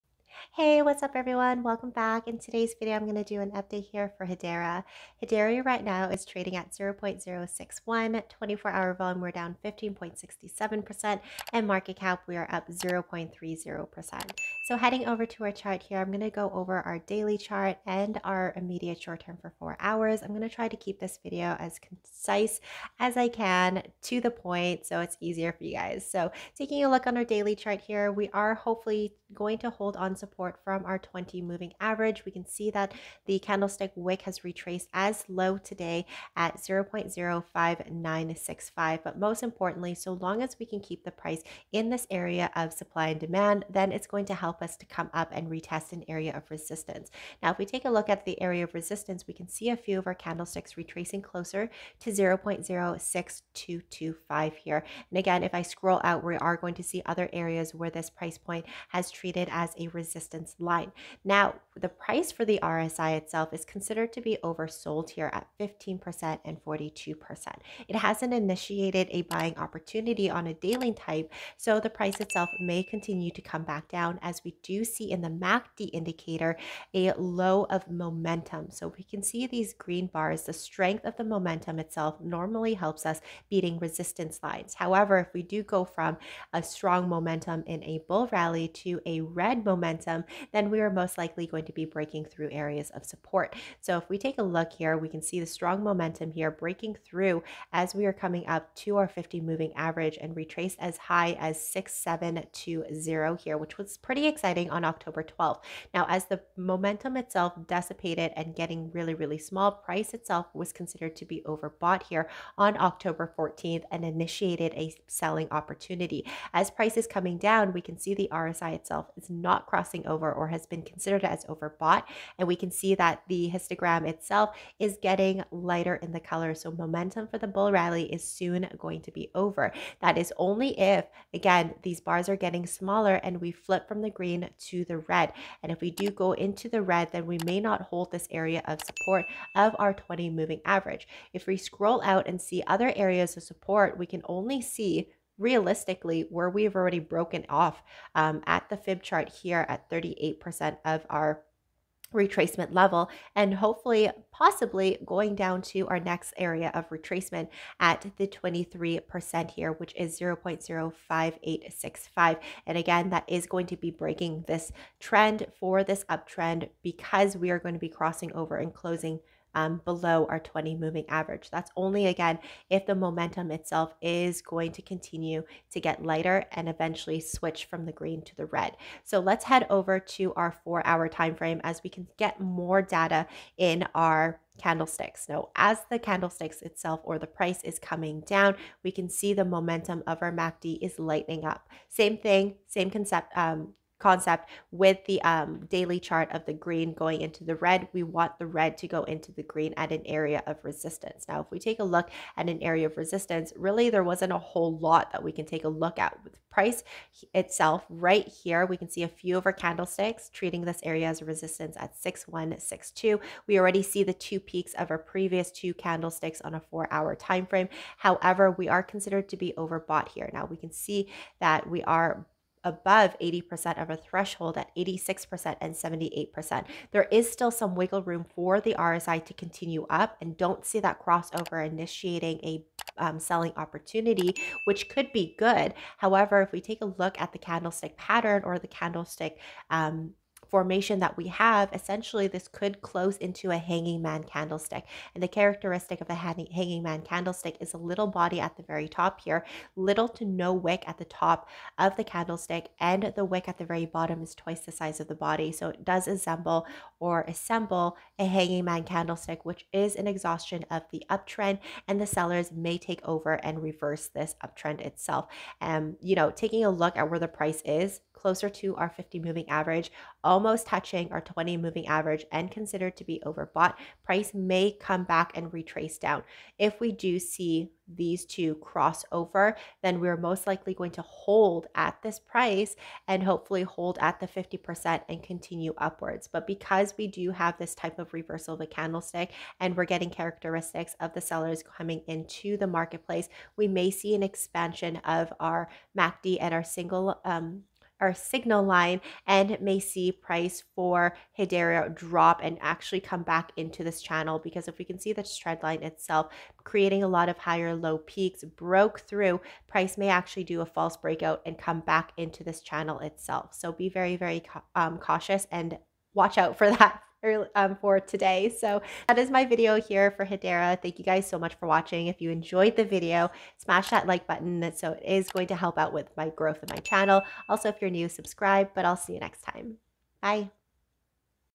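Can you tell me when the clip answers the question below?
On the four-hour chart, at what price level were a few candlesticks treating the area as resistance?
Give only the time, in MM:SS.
03:31.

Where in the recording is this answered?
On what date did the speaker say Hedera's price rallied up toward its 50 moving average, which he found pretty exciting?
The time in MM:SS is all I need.
01:44.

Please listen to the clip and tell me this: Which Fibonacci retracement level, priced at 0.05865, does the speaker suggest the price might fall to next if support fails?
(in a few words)
23%.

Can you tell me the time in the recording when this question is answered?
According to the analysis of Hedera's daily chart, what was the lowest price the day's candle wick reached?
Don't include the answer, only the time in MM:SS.
00:36.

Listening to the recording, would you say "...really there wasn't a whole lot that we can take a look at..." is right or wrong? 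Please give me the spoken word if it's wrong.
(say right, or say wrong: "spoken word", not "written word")
right.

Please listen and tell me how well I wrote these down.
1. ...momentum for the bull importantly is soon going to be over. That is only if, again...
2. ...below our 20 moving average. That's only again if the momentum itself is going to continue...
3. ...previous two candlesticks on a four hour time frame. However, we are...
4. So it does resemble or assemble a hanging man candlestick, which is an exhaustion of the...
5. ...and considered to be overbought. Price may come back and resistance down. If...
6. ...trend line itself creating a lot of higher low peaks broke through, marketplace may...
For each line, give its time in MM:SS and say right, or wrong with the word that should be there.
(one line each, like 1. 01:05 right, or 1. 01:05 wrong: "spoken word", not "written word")
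1. 02:06 wrong: "rally", not "importantly"
2. 02:49 right
3. 03:34 right
4. 04:15 right
5. 04:32 wrong: "retrace", not "resistance"
6. 05:05 wrong: "price", not "marketplace".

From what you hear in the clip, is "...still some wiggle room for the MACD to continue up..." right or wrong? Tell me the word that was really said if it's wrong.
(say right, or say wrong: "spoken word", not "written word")
wrong: "RSI", not "MACD".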